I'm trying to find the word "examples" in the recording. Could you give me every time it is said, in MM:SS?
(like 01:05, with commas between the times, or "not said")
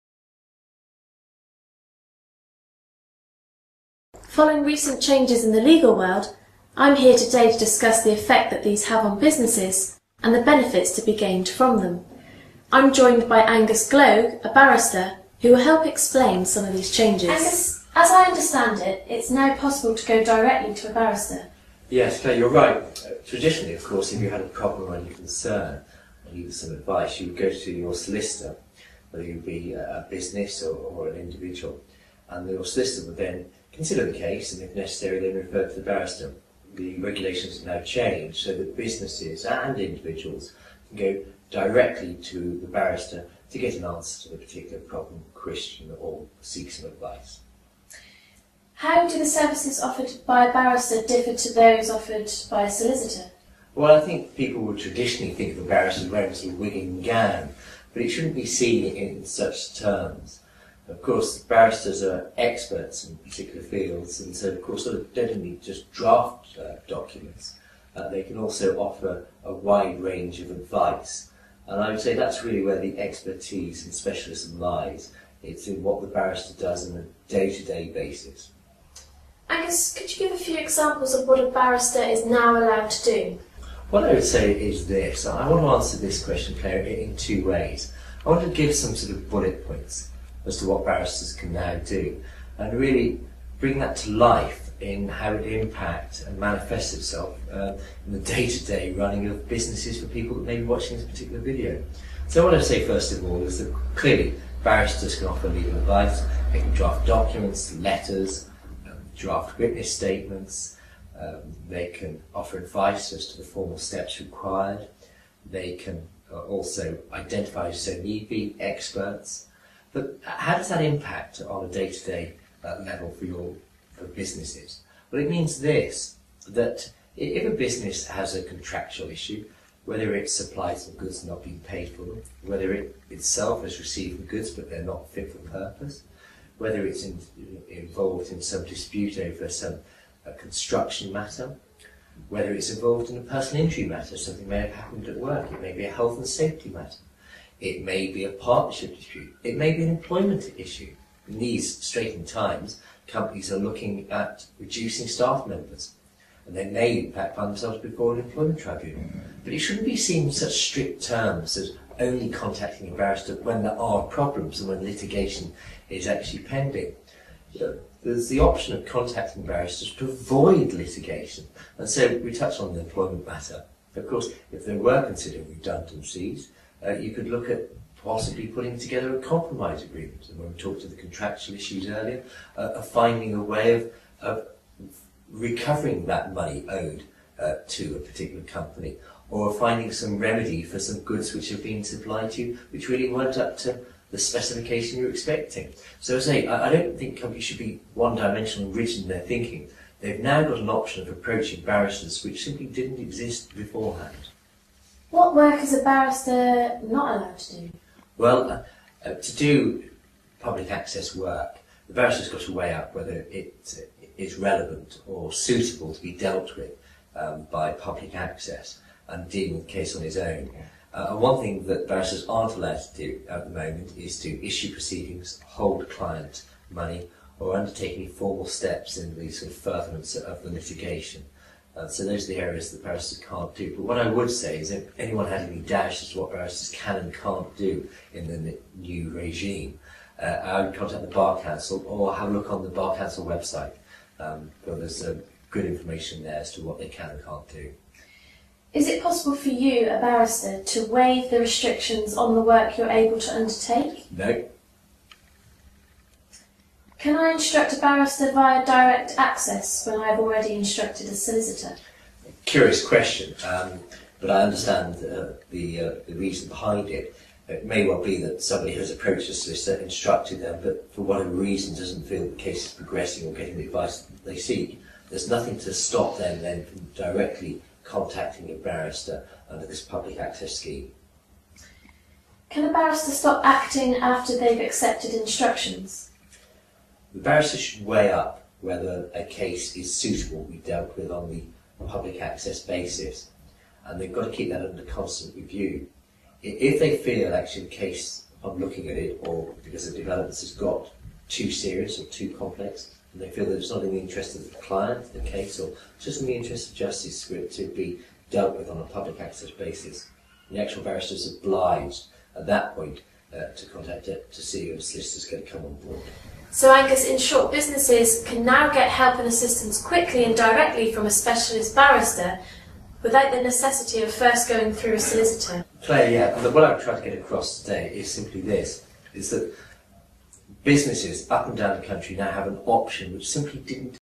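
01:20.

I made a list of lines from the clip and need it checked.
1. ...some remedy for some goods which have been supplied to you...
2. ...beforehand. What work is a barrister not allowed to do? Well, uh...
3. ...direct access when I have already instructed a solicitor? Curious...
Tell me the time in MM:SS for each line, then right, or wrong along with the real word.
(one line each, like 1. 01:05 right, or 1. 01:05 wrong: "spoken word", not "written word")
1. 03:09 right
2. 03:23 right
3. 04:18 right.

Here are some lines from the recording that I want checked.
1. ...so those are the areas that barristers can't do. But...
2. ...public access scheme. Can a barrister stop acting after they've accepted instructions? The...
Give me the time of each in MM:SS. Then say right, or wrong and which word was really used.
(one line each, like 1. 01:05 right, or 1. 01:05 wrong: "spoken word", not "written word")
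1. 03:51 right
2. 04:39 right.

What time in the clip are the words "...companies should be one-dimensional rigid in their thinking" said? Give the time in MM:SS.
03:17.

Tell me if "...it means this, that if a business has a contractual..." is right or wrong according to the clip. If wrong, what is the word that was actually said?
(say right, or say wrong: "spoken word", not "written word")
right.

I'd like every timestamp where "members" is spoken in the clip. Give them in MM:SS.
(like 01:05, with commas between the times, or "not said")
02:35.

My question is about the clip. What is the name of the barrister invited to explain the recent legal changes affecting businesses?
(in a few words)
Angus Gloag.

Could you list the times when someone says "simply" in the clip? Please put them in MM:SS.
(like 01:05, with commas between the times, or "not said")
03:22, 05:28, 05:33.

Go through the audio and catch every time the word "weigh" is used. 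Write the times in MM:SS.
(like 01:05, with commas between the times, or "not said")
03:32, 04:47.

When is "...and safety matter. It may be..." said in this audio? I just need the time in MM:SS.
02:26.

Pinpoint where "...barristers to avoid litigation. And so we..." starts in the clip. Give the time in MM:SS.
02:49.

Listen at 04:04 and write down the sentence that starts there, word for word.
Um, but there's uh, good information there as to what they can and can't do.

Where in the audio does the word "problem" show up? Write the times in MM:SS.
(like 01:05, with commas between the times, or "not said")
00:24, 00:44, 02:44.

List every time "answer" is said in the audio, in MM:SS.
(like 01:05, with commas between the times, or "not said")
00:43, 01:25.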